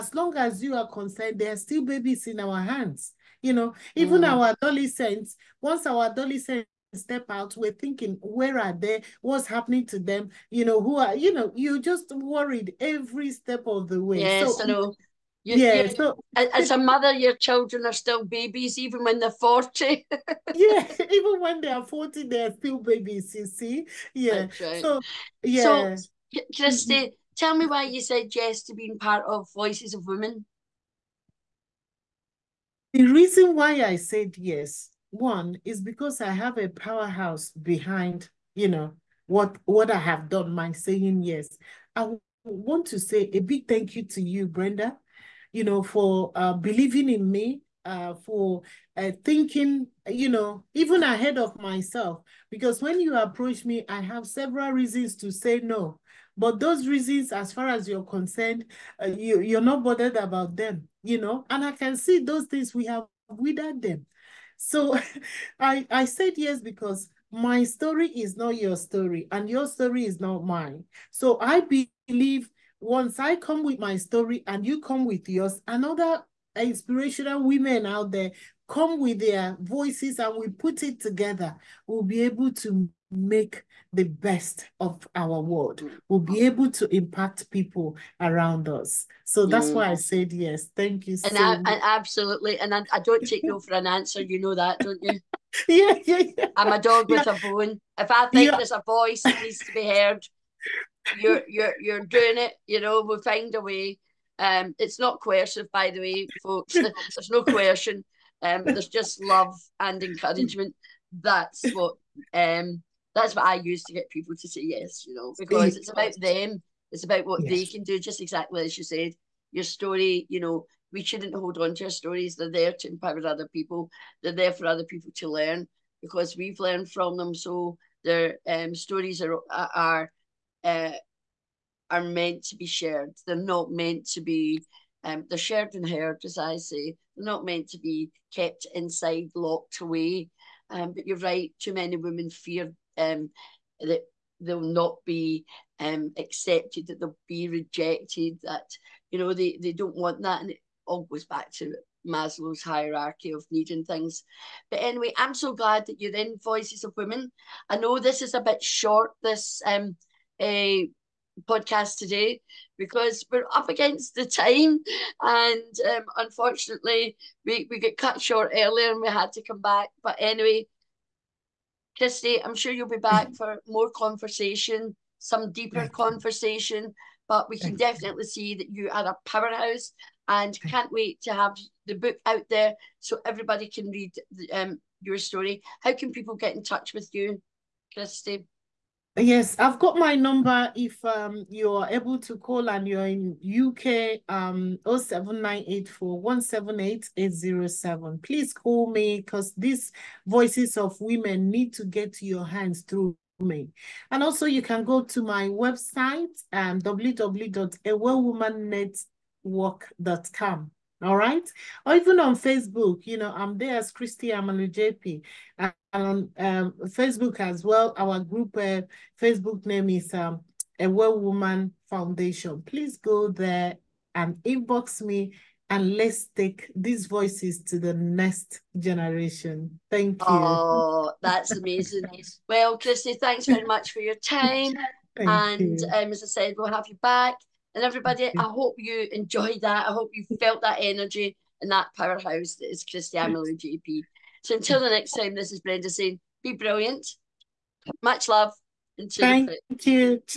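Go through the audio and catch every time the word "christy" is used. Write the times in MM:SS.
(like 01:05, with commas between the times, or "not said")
00:26, 02:51, 03:07, 03:33, 03:52, 04:02.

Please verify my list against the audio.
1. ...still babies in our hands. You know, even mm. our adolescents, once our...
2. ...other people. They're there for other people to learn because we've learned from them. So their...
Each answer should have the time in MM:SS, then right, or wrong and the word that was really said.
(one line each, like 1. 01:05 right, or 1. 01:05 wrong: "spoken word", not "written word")
1. 00:01 right
2. 02:03 right.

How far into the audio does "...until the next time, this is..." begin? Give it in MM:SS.
04:04.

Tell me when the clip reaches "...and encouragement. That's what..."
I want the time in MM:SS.
01:49.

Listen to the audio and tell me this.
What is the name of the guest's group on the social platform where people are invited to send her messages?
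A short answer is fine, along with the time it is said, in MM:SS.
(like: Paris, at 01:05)
A Well Woman Foundation, at 03:40.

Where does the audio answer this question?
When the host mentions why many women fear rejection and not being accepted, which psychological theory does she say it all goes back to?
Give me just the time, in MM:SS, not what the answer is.
02:32.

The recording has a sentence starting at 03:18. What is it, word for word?
Please call me because these voices of women need to get to your hands through me.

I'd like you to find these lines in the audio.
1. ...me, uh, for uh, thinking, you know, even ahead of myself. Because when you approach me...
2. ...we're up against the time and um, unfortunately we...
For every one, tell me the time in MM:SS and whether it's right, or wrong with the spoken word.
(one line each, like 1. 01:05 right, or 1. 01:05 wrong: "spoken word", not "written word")
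1. 00:47 right
2. 02:43 right.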